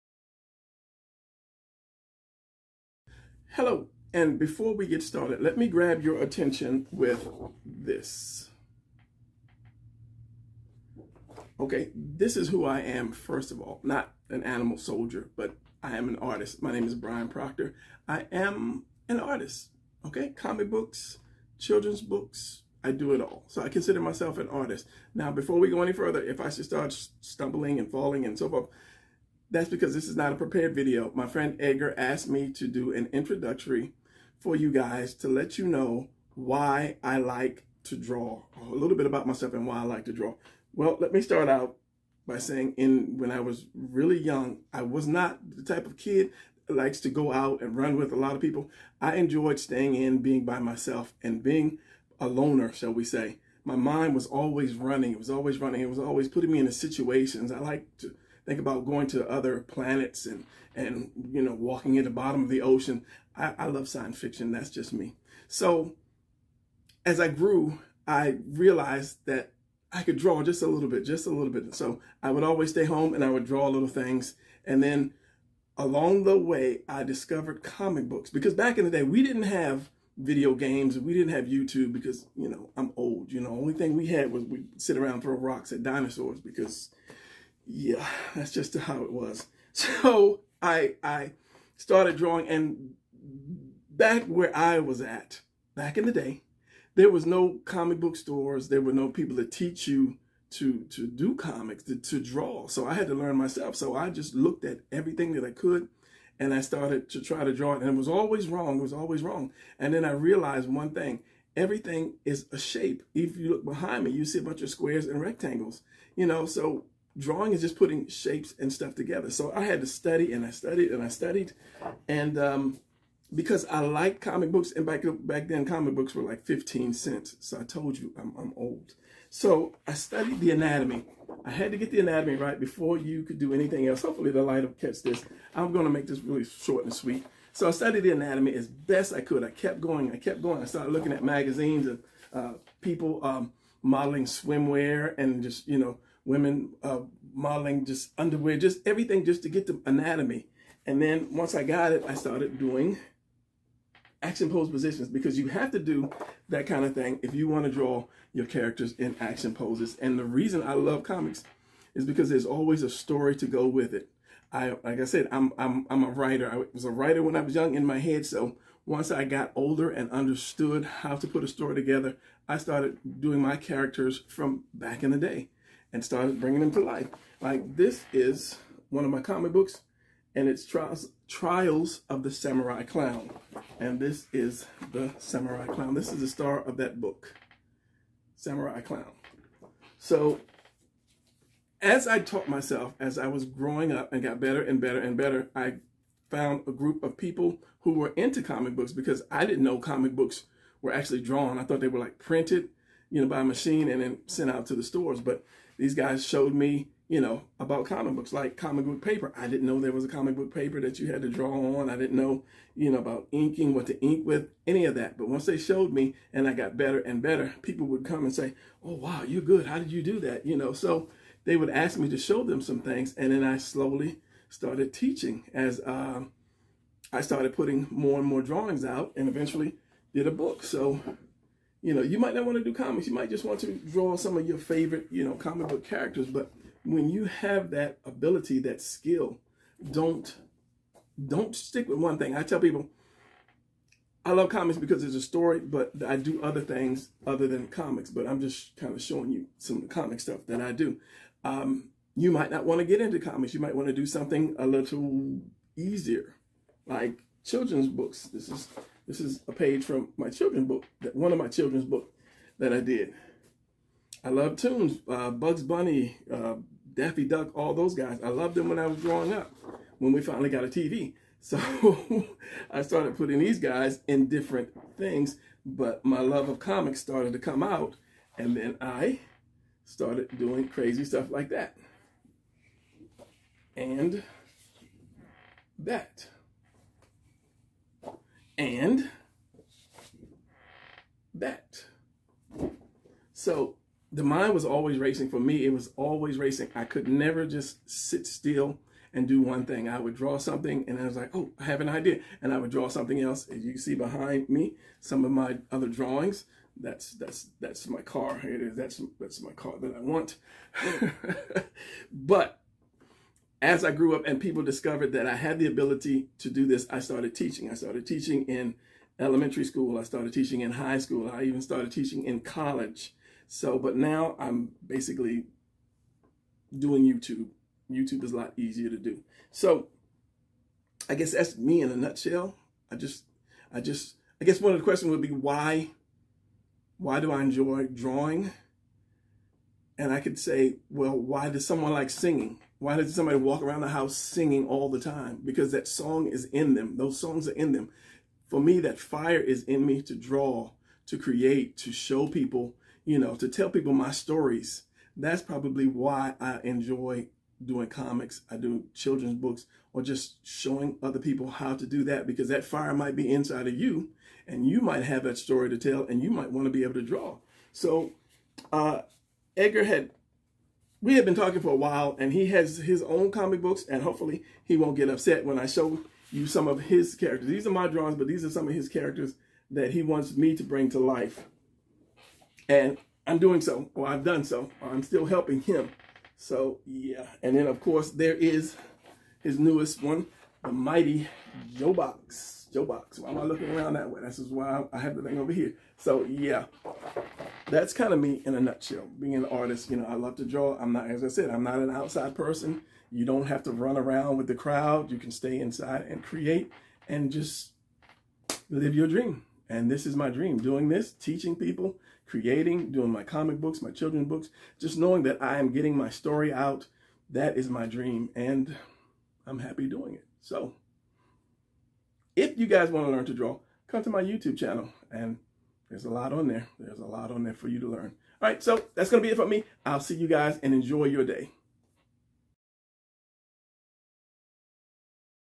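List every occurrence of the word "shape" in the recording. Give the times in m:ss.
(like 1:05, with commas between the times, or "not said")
1:52, 1:58.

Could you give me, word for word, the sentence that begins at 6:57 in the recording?
That is my dream, and I'm happy doing it.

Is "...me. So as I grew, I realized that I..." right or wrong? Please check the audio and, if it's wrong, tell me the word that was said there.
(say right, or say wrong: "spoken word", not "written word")
right.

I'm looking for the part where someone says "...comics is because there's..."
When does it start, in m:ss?
2:41.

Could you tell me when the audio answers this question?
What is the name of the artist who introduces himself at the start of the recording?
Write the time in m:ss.
0:16.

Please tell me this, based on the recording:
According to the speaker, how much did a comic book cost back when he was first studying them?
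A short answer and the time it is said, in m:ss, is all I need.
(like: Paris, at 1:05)
15 cents, at 2:06.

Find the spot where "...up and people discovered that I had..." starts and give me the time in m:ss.
5:14.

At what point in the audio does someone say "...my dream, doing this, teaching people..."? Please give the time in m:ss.
6:50.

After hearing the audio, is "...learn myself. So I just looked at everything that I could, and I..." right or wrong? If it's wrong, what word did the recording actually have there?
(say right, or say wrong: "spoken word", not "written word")
right.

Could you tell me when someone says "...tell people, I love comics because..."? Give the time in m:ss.
4:02.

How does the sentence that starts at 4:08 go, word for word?
But I'm just kind of showing you some of the comic stuff that I do.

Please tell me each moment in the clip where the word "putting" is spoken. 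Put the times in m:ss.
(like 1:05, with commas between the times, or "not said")
0:56, 1:57, 3:47, 4:33.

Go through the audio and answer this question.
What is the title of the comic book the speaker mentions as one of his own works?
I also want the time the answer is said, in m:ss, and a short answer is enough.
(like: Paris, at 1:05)
Trials of the Samurai Clown, at 3:01.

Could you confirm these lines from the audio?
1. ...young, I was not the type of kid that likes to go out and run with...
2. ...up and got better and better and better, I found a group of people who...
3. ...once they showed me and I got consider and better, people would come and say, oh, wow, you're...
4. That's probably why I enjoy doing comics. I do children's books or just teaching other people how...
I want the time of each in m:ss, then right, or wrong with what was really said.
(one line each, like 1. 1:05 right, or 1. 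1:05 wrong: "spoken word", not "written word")
1. 0:44 right
2. 3:13 right
3. 3:35 wrong: "better", not "consider"
4. 5:55 wrong: "showing", not "teaching".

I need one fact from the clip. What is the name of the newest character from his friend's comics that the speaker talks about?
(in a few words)
the Mighty Joe Box.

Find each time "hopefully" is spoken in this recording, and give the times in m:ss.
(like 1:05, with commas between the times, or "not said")
2:14, 6:14.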